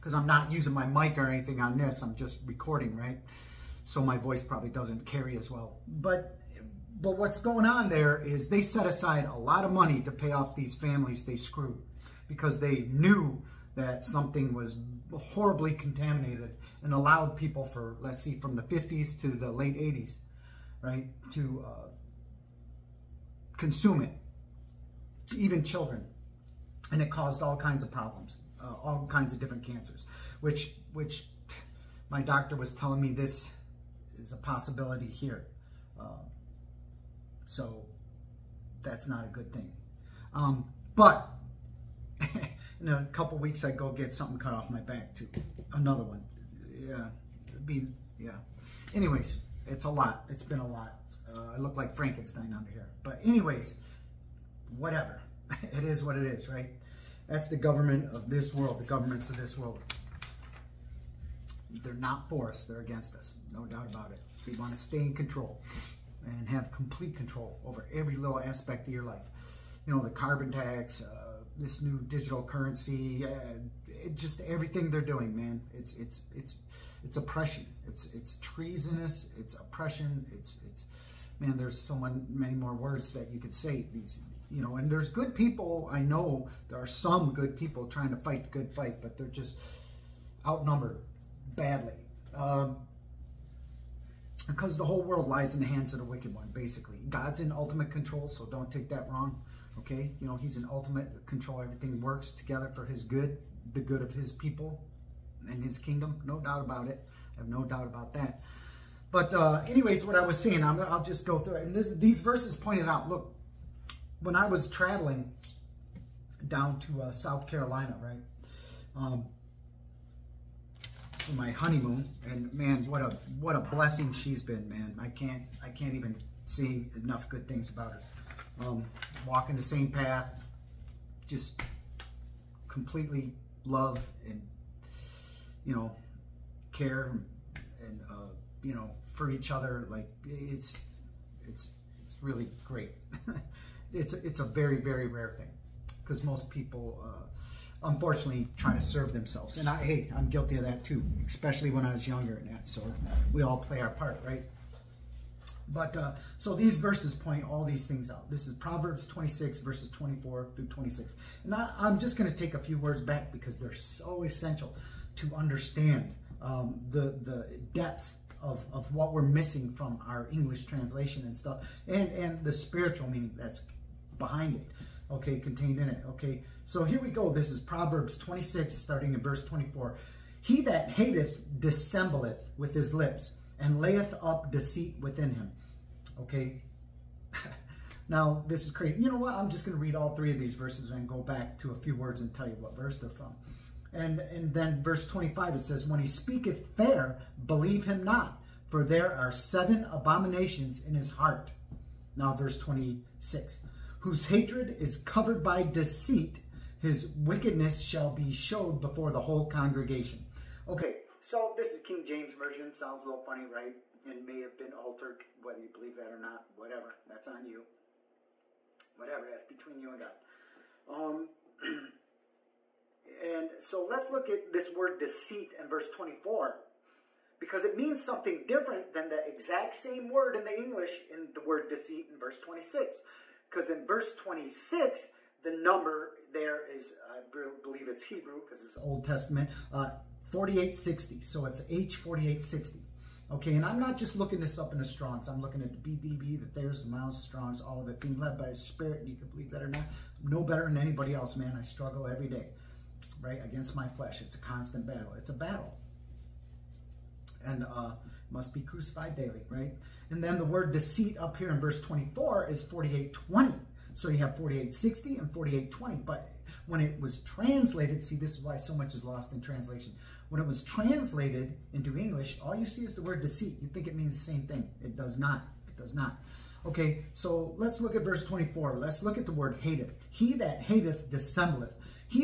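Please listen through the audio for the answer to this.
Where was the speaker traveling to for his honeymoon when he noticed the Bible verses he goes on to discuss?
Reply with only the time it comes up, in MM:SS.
01:57.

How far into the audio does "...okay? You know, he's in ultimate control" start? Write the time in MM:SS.
01:39.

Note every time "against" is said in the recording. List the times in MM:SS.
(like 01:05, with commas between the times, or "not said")
01:02, 04:13.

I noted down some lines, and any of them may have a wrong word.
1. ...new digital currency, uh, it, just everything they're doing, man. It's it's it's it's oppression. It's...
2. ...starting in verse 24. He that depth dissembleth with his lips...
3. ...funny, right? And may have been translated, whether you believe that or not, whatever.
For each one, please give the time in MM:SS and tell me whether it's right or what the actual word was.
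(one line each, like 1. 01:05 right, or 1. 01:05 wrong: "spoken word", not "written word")
1. 01:11 right
2. 02:58 wrong: "hateth", not "depth"
3. 03:33 wrong: "altered", not "translated".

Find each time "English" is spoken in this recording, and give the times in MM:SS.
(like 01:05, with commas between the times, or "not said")
02:50, 03:50, 04:31.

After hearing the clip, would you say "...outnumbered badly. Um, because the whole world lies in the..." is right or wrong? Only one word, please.
right.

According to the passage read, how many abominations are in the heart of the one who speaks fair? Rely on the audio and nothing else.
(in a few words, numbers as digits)
7.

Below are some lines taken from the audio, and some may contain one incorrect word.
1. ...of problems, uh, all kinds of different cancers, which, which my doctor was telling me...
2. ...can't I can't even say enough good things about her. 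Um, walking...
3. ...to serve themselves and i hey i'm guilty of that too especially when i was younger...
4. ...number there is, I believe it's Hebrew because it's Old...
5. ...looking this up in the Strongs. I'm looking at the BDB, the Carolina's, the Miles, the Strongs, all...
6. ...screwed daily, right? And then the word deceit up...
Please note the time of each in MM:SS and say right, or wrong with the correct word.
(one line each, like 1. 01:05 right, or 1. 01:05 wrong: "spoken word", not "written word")
1. 00:27 right
2. 02:05 right
3. 02:28 right
4. 03:55 right
5. 04:04 wrong: "Thayer", not "Carolina"
6. 04:18 wrong: "crucified", not "screwed".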